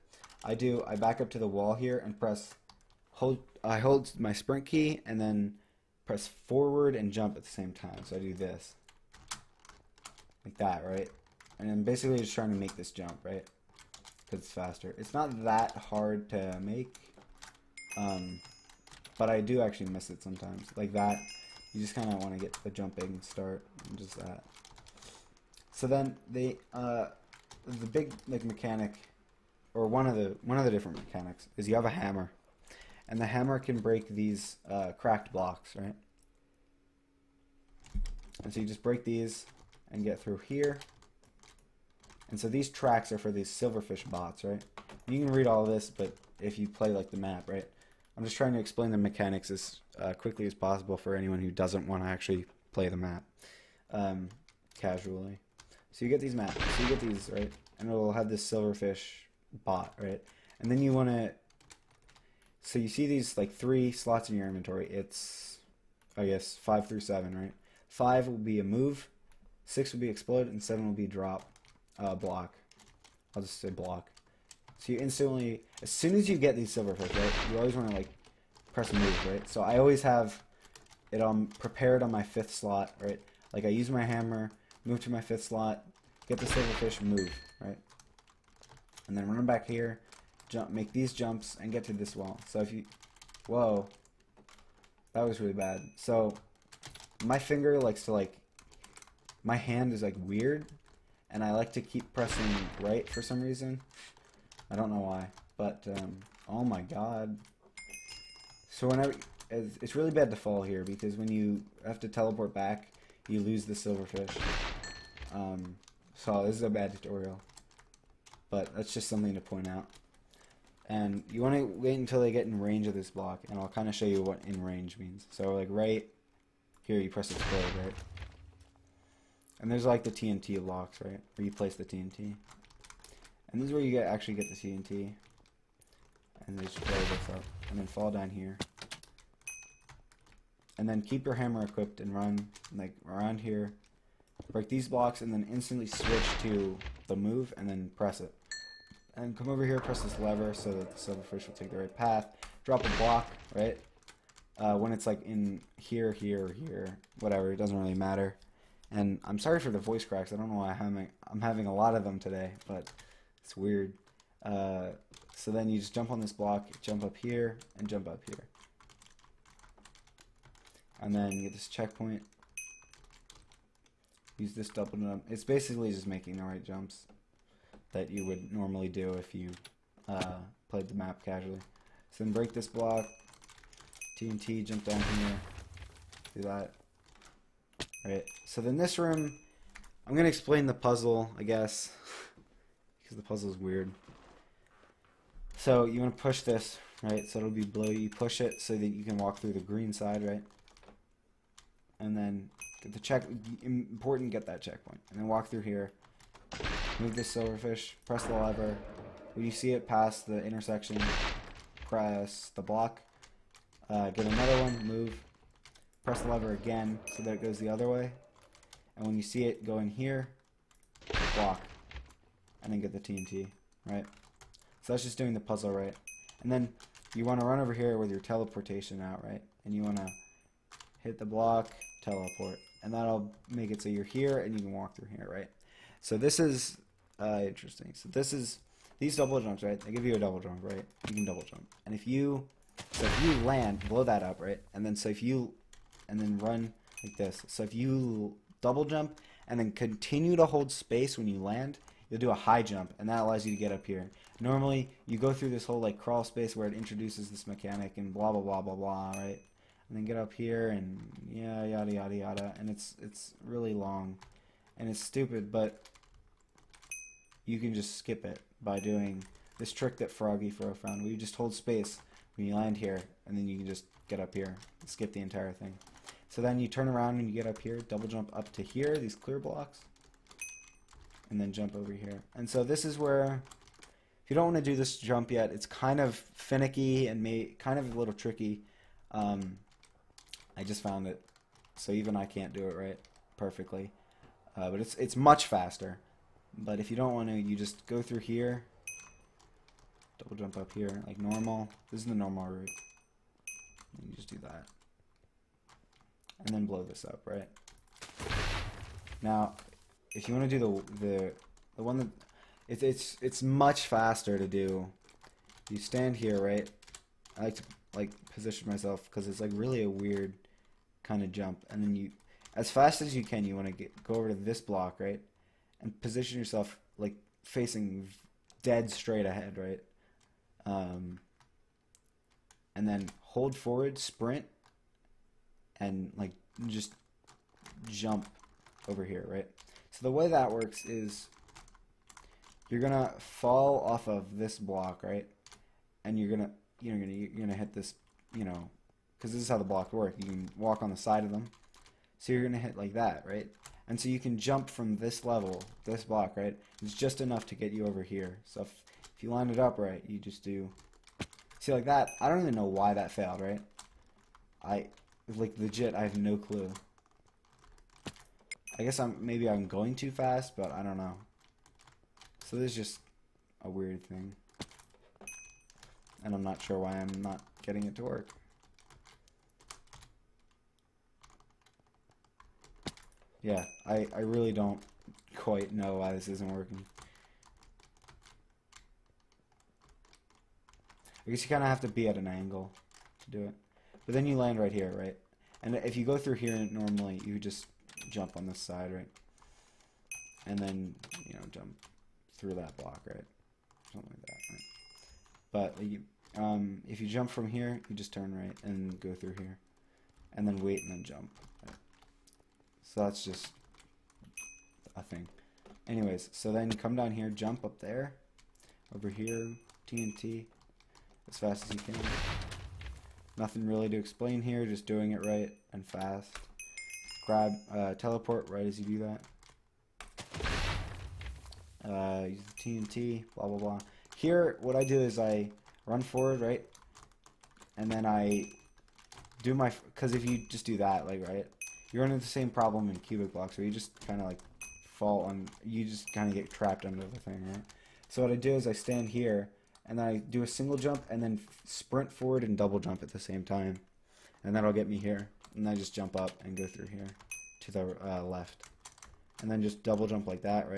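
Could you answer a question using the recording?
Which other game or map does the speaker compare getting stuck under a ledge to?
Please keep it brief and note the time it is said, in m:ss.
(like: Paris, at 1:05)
Cubic blocks, at 7:22.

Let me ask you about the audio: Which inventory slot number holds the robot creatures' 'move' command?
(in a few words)
5.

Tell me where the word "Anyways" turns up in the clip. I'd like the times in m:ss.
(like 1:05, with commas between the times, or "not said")
6:55.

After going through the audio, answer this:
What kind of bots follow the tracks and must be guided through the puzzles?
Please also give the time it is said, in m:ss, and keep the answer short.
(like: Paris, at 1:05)
Silverfish bots, at 0:43.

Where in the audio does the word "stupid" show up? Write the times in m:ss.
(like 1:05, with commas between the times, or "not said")
4:25.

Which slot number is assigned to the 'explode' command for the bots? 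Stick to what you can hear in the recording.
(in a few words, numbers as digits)
6.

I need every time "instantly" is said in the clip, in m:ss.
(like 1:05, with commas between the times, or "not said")
1:15, 2:25.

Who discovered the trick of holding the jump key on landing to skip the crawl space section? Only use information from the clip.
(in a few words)
Froggy Fro.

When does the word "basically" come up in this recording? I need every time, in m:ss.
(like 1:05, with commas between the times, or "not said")
0:11, 2:55.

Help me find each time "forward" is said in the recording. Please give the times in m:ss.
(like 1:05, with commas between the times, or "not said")
0:06, 5:33, 7:16, 7:32.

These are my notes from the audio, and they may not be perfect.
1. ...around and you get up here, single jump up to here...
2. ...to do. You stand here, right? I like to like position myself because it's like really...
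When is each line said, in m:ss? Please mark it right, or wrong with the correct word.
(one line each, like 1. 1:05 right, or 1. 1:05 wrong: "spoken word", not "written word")
1. 4:36 wrong: "double", not "single"
2. 5:14 right.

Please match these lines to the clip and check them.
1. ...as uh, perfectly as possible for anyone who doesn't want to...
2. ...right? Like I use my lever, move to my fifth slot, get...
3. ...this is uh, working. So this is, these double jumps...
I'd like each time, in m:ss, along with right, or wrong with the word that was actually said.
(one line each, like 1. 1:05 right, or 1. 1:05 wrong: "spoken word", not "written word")
1. 0:49 wrong: "quickly", not "perfectly"
2. 1:23 wrong: "hammer", not "lever"
3. 3:56 wrong: "interesting", not "working".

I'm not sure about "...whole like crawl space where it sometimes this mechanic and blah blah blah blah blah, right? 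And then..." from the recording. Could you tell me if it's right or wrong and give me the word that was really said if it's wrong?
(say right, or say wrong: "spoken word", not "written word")
wrong: "introduces", not "sometimes".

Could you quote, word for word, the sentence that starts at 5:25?
And position yourself like facing dead straight ahead, right?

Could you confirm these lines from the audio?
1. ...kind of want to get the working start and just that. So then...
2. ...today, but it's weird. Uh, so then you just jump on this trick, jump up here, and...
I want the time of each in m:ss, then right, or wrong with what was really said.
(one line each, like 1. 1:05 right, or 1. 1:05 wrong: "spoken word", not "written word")
1. 0:21 wrong: "jumping", not "working"
2. 2:42 wrong: "block", not "trick".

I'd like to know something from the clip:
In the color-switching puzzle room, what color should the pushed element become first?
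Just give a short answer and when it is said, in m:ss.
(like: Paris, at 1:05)
Blue, at 3:17.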